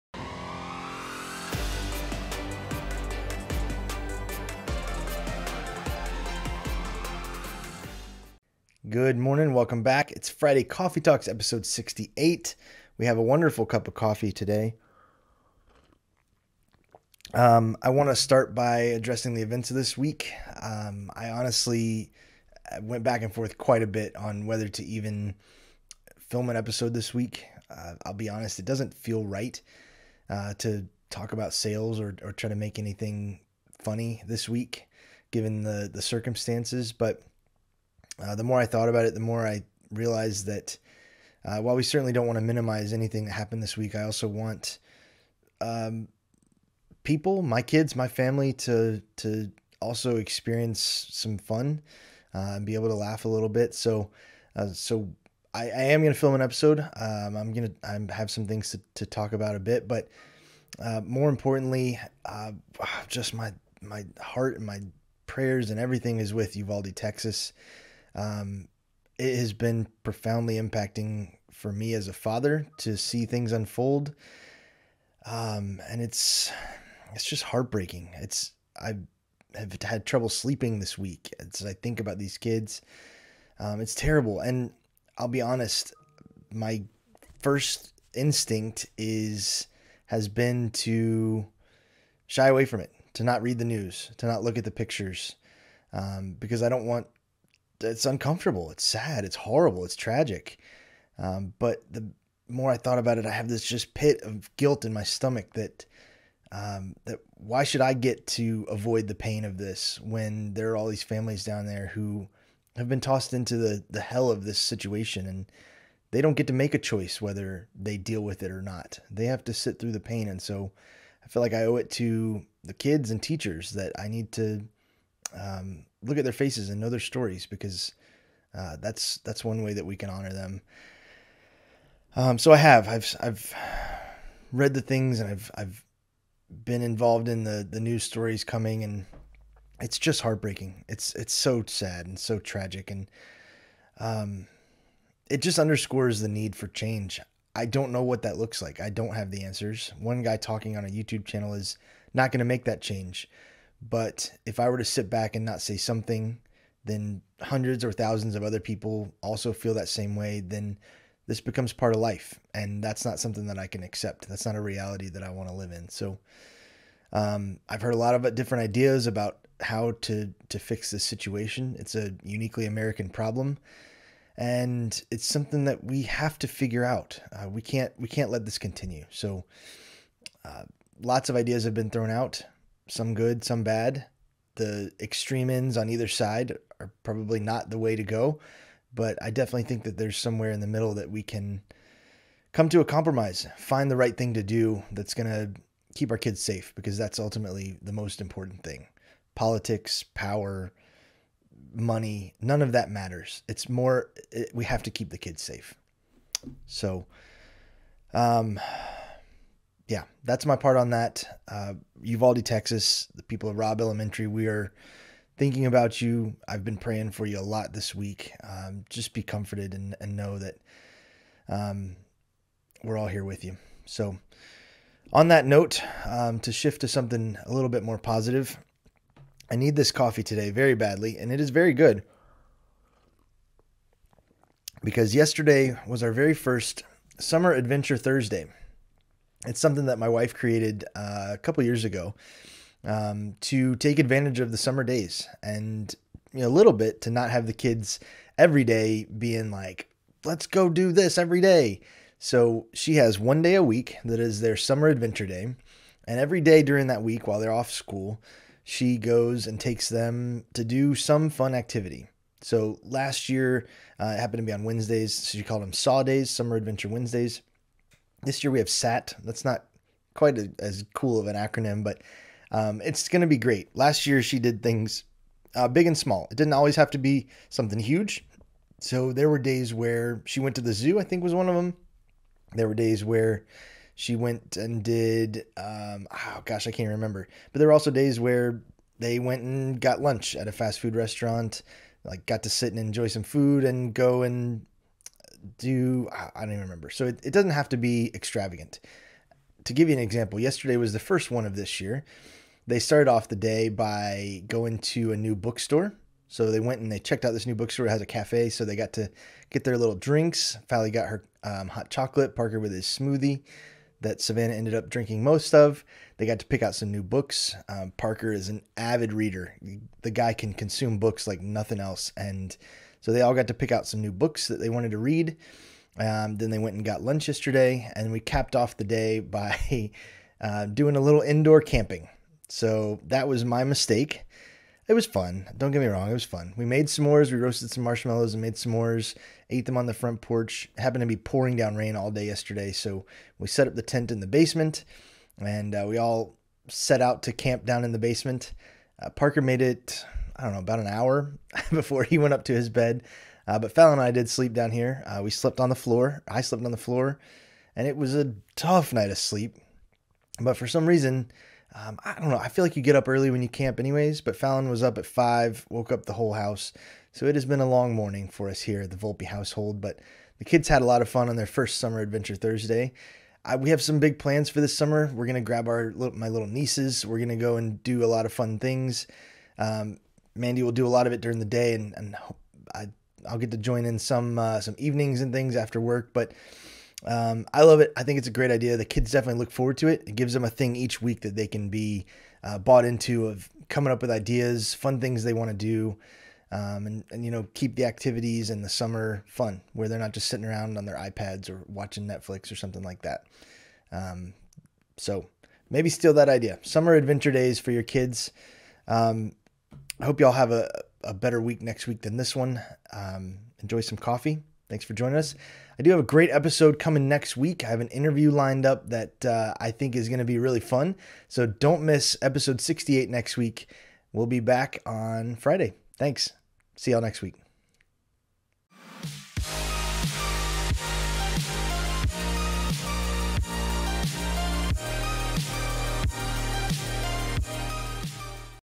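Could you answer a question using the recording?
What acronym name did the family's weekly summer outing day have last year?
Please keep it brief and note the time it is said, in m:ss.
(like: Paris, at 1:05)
Saw Days, at 4:25.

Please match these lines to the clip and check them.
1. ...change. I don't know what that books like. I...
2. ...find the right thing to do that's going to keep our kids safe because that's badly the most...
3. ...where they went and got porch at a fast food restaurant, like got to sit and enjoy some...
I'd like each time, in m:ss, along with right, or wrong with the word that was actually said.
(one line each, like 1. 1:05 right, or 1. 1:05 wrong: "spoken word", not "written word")
1. 2:26 wrong: "looks", not "books"
2. 3:13 wrong: "ultimately", not "badly"
3. 4:48 wrong: "lunch", not "porch".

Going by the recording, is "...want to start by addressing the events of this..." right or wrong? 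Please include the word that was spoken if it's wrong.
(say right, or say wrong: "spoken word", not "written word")
right.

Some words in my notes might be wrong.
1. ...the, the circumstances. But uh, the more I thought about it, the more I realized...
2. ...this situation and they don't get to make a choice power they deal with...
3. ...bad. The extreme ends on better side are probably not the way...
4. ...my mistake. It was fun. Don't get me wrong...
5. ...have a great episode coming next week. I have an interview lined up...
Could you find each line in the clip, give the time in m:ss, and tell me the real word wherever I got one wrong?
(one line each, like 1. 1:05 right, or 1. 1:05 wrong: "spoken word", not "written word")
1. 0:35 right
2. 1:54 wrong: "whether", not "power"
3. 3:03 wrong: "either", not "better"
4. 5:33 right
5. 6:55 right.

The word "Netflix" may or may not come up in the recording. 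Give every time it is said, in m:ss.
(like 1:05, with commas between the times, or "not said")
6:42.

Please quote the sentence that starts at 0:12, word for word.
We have a wonderful cup of coffee today.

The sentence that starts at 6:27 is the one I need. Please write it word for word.
I think it's a great idea.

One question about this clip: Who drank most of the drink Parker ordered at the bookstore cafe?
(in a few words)
Savannah.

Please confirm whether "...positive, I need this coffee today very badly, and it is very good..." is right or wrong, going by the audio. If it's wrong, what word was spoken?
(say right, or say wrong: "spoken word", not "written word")
right.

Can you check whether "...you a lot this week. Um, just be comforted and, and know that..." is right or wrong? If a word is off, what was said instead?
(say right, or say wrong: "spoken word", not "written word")
right.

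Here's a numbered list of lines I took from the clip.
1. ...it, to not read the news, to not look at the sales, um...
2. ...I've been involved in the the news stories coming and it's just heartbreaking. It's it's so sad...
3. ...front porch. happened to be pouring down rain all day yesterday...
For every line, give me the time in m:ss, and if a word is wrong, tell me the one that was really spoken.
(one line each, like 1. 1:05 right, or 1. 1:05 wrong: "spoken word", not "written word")
1. 1:32 wrong: "pictures", not "sales"
2. 2:15 right
3. 5:39 right.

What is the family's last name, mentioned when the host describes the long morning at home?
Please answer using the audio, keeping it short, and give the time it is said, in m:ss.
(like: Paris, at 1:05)
Volpe, at 6:08.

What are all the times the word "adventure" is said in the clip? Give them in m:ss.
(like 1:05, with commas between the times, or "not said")
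3:57, 4:14, 4:26, 6:11, 6:46.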